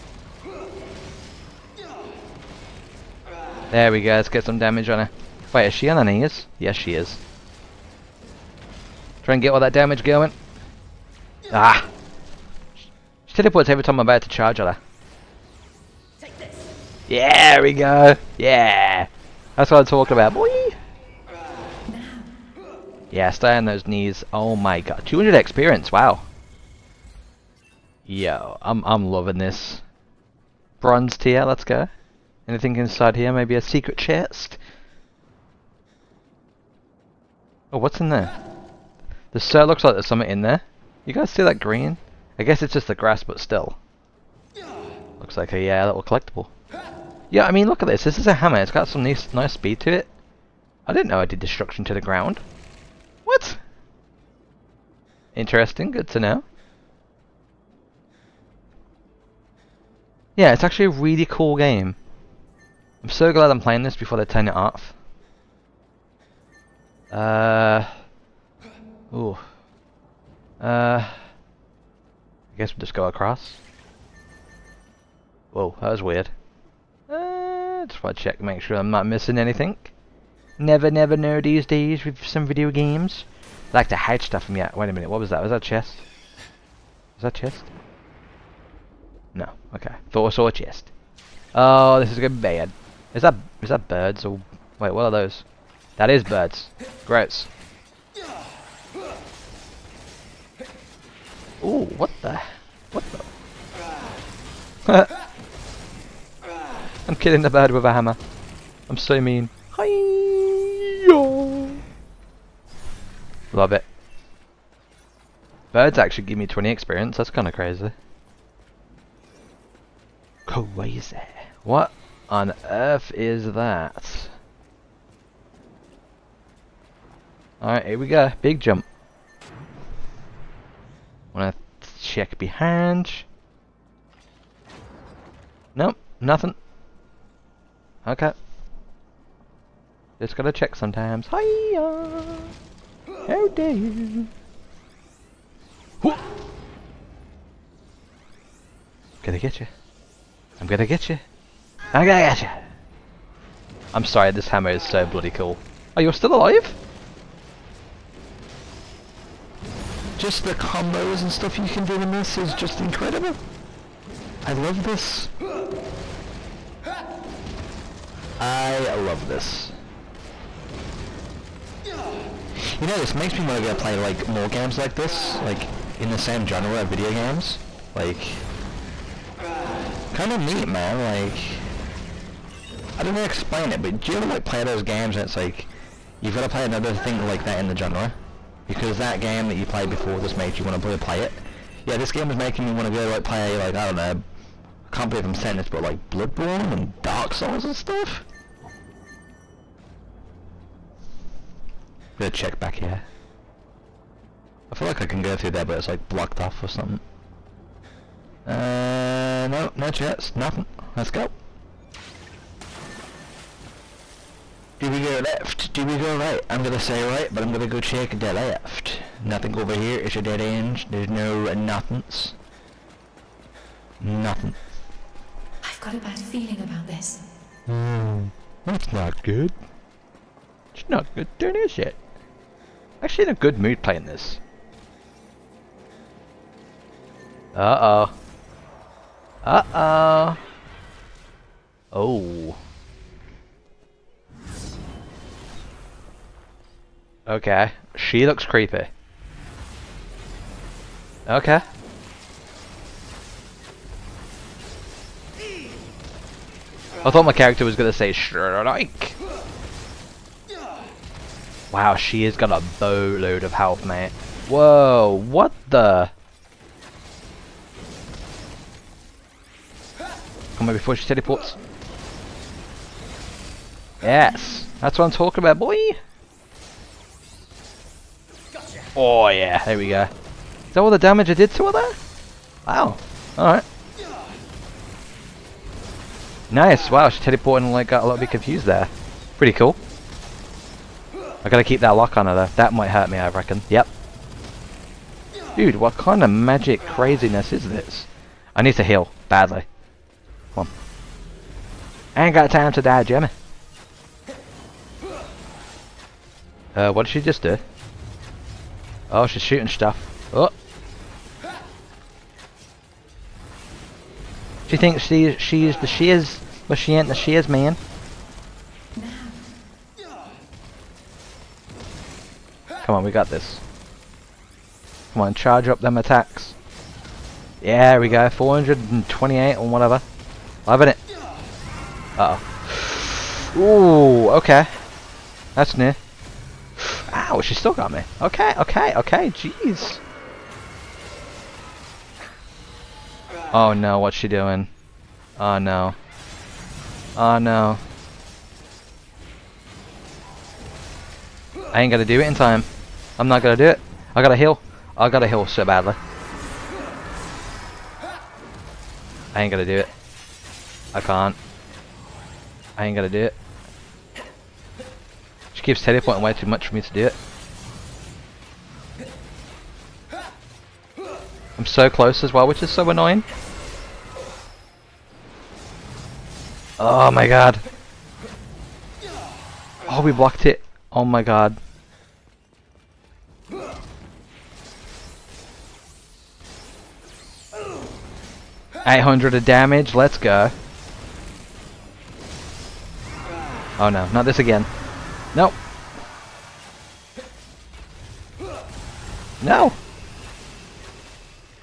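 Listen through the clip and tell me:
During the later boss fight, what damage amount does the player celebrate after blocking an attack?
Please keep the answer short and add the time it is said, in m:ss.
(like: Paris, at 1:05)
800, at 6:28.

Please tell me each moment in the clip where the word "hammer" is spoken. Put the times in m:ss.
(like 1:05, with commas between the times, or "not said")
0:48, 1:47, 2:34.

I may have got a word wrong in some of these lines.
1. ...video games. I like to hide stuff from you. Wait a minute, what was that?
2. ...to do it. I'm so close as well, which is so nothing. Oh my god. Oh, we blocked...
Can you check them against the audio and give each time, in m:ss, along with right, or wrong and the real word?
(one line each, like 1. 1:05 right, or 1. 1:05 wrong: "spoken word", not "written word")
1. 1:22 right
2. 6:06 wrong: "annoying", not "nothing".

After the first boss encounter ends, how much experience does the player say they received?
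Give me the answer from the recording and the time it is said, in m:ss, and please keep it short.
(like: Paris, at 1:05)
200, at 0:25.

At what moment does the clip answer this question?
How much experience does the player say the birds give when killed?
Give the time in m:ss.
1:56.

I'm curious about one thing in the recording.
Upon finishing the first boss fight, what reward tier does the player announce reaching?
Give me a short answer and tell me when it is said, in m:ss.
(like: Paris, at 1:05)
Bronze, at 0:30.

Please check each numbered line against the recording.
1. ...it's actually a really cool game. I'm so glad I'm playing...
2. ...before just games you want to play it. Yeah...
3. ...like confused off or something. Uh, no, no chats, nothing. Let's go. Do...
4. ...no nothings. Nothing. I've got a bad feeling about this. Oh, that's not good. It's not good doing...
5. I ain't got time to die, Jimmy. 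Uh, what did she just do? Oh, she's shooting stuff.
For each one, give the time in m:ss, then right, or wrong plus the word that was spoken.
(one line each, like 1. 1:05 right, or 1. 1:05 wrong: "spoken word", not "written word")
1. 1:00 right
2. 3:09 wrong: "makes", not "games"
3. 3:25 wrong: "blocked", not "confused"
4. 3:41 right
5. 5:02 right.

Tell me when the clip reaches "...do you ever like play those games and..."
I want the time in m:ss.
3:04.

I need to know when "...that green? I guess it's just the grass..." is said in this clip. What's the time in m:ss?
0:41.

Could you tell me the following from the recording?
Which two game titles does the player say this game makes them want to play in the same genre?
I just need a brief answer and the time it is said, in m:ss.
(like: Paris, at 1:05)
Bloodborne and Dark Souls, at 3:16.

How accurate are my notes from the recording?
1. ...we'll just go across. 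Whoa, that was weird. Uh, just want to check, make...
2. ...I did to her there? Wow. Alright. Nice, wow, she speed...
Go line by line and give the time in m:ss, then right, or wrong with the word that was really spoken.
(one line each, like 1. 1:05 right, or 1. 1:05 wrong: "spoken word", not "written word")
1. 1:12 right
2. 4:41 wrong: "teleported", not "speed".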